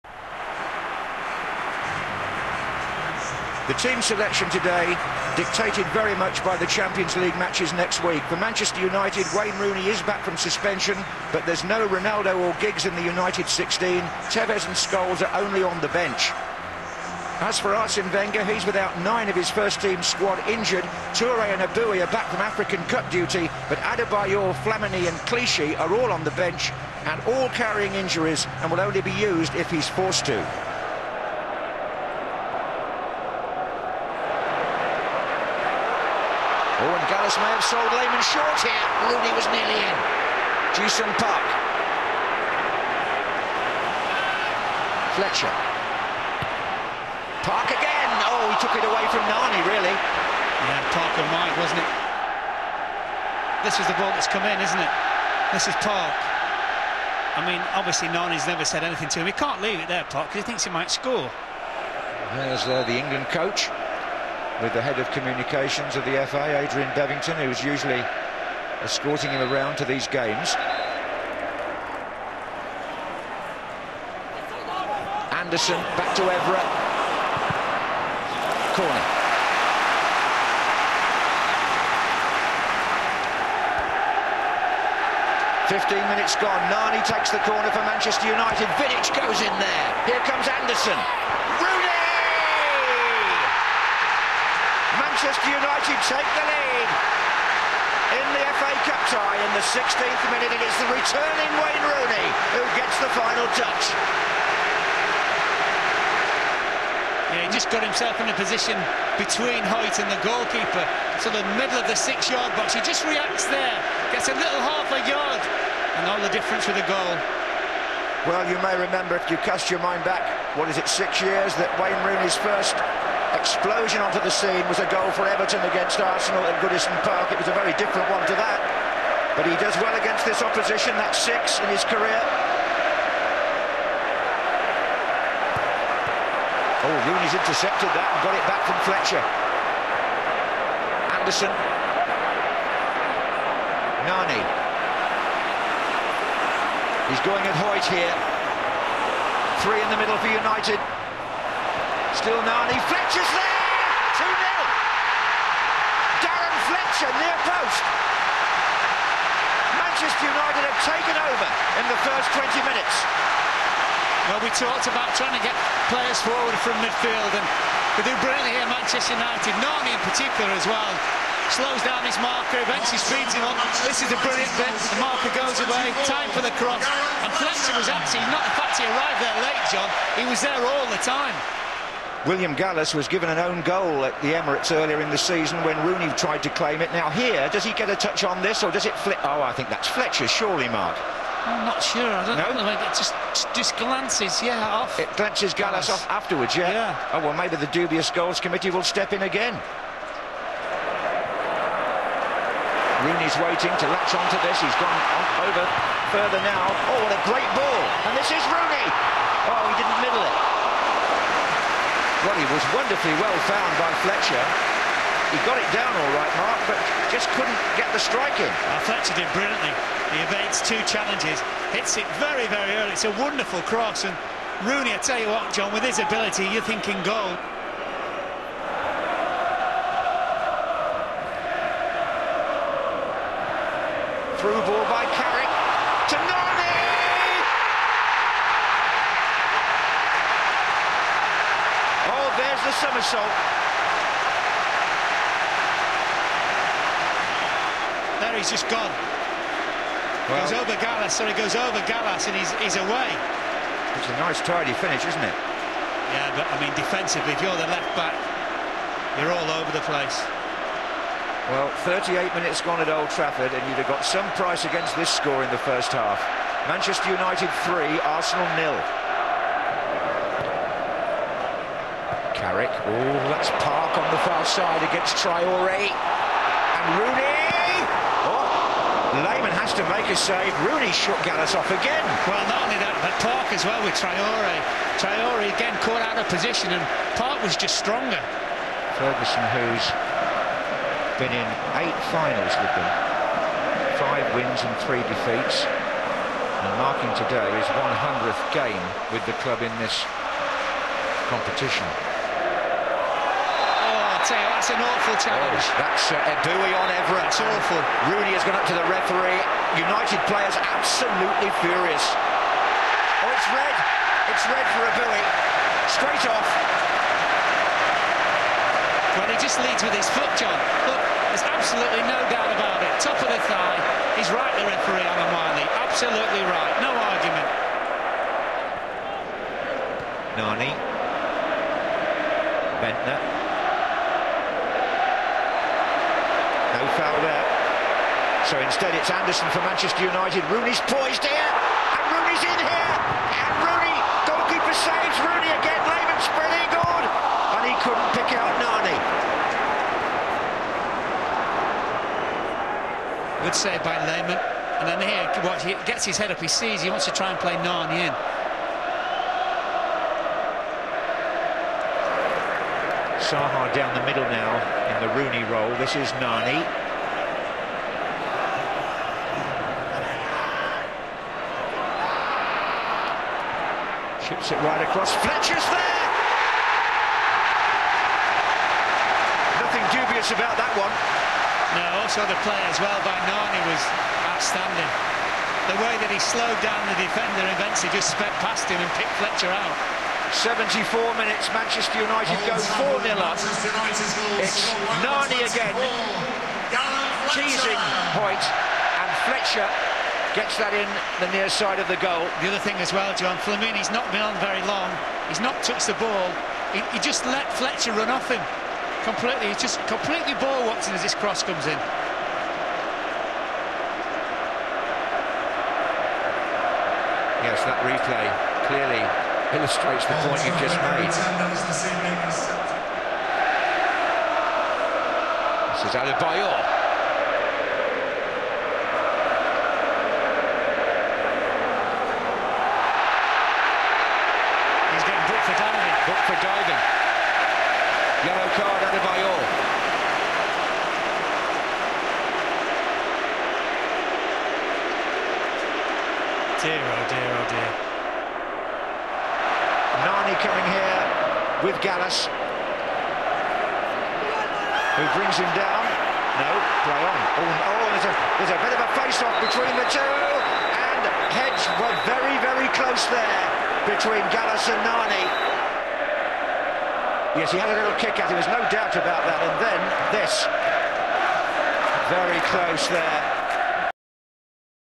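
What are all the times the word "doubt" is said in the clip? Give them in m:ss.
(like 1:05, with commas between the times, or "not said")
5:22, 7:48.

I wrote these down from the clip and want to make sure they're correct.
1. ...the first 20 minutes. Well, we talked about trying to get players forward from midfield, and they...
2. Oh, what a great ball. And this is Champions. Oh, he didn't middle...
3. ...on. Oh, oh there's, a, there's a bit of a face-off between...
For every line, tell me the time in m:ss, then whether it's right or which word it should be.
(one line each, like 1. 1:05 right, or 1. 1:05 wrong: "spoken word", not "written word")
1. 2:41 right
2. 3:26 wrong: "Rooney", not "Champions"
3. 7:37 right.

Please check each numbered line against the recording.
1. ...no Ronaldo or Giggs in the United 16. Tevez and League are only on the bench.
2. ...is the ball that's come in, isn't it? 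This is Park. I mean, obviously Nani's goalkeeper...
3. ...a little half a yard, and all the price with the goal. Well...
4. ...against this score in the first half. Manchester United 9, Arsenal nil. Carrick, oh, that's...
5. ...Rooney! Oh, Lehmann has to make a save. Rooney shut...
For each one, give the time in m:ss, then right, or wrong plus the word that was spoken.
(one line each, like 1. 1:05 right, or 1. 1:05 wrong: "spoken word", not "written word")
1. 0:11 wrong: "Scholes", not "League"
2. 0:53 wrong: "never", not "goalkeeper"
3. 1:54 wrong: "difference", not "price"
4. 4:24 wrong: "3", not "9"
5. 4:36 right.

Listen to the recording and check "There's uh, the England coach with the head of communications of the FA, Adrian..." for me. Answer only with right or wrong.
right.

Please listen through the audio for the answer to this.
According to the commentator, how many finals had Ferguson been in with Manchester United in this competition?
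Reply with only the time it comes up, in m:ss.
4:51.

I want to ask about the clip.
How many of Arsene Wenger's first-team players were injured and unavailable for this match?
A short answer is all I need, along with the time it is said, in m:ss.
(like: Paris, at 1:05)
9, at 0:19.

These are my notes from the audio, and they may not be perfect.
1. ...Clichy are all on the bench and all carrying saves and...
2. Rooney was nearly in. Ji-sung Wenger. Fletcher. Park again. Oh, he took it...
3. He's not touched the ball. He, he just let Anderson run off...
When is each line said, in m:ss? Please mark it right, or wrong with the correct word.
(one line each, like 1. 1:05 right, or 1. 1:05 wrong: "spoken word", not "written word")
1. 0:25 wrong: "injuries", not "saves"
2. 0:39 wrong: "Park", not "Wenger"
3. 6:45 wrong: "Fletcher", not "Anderson".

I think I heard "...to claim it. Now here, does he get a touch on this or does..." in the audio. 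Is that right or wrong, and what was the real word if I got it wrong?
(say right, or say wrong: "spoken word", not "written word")
right.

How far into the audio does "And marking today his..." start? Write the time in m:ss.
4:55.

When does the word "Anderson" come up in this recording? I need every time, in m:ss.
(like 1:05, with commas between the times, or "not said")
1:15, 1:30, 2:21, 5:39.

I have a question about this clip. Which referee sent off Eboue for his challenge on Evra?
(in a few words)
Alan Wiley.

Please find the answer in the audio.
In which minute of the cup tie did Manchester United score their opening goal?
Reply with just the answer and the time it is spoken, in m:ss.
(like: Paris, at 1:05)
16th, at 1:39.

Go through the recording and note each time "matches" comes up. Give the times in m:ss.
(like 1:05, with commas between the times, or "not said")
0:07.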